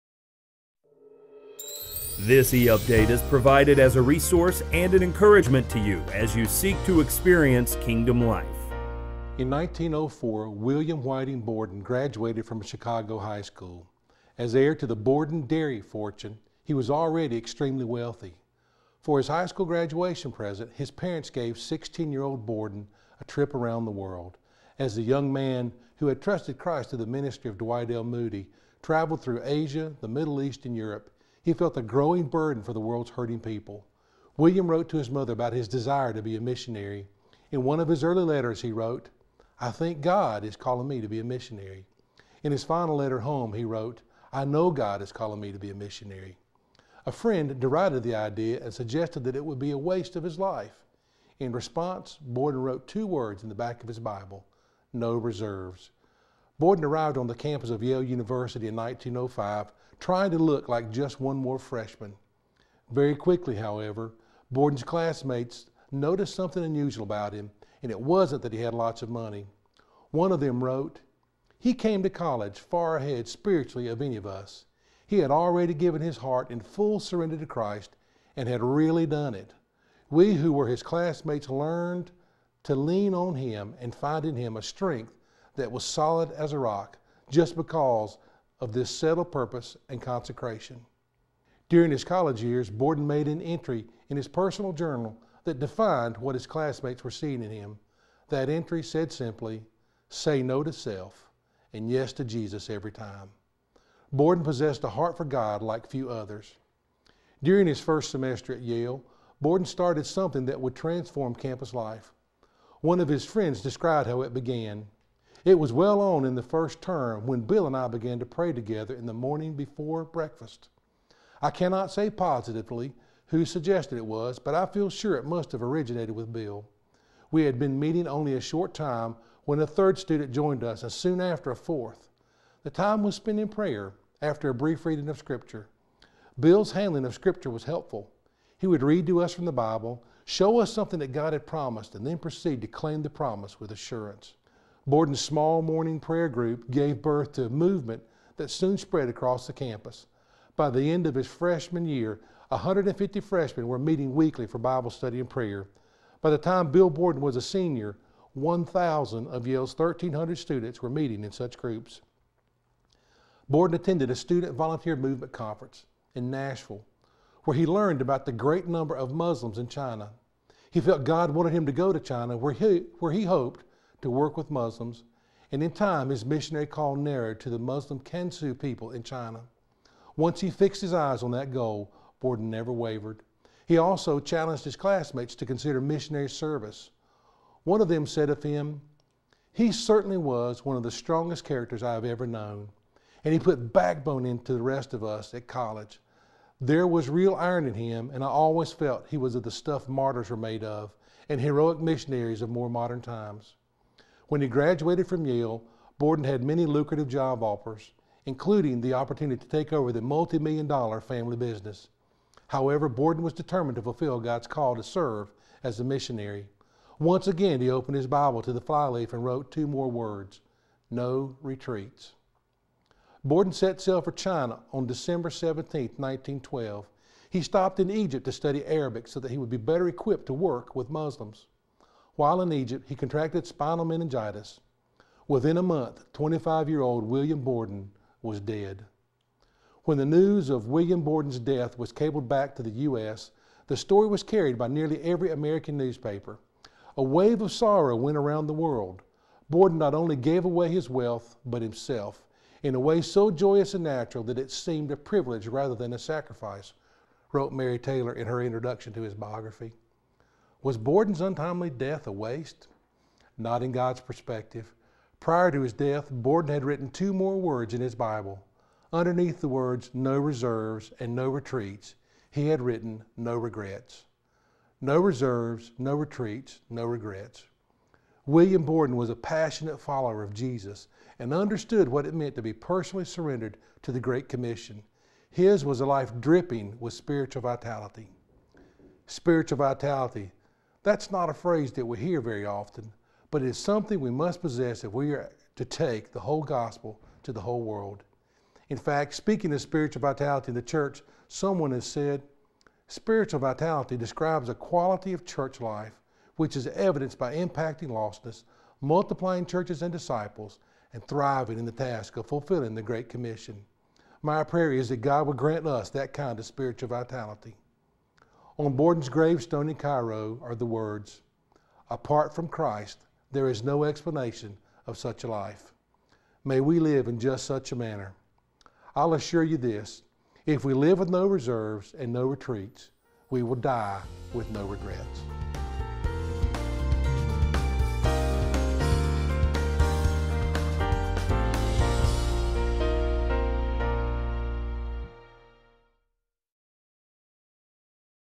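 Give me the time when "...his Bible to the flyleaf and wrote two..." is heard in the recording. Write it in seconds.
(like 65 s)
217 s.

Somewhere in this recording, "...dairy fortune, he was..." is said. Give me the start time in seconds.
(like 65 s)
15 s.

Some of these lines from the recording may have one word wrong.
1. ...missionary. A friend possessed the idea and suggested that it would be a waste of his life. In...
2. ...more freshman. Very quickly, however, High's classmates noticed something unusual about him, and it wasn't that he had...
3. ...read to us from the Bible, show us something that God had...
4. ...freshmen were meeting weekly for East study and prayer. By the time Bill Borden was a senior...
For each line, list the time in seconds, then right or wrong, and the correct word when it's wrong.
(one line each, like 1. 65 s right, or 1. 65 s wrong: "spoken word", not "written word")
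1. 45 s wrong: "derided", not "possessed"
2. 61 s wrong: "Borden", not "High"
3. 138 s right
4. 153 s wrong: "Bible", not "East".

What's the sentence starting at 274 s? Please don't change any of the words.
No reserves, no retreats, no regrets.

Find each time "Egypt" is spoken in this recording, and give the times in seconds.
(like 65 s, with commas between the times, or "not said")
227 s, 232 s.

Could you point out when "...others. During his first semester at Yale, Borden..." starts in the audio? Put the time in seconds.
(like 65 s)
106 s.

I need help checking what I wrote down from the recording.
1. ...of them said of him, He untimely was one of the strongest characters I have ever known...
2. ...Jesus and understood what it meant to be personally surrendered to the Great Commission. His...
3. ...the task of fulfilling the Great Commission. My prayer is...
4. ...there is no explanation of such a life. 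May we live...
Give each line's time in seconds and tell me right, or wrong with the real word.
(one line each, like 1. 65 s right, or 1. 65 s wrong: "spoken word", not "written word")
1. 187 s wrong: "certainly", not "untimely"
2. 280 s right
3. 311 s right
4. 323 s right.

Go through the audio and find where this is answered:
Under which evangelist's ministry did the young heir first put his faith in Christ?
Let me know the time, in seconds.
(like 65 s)
27 s.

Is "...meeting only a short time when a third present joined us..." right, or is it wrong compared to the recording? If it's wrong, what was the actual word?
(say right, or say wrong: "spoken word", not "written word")
wrong: "student", not "present".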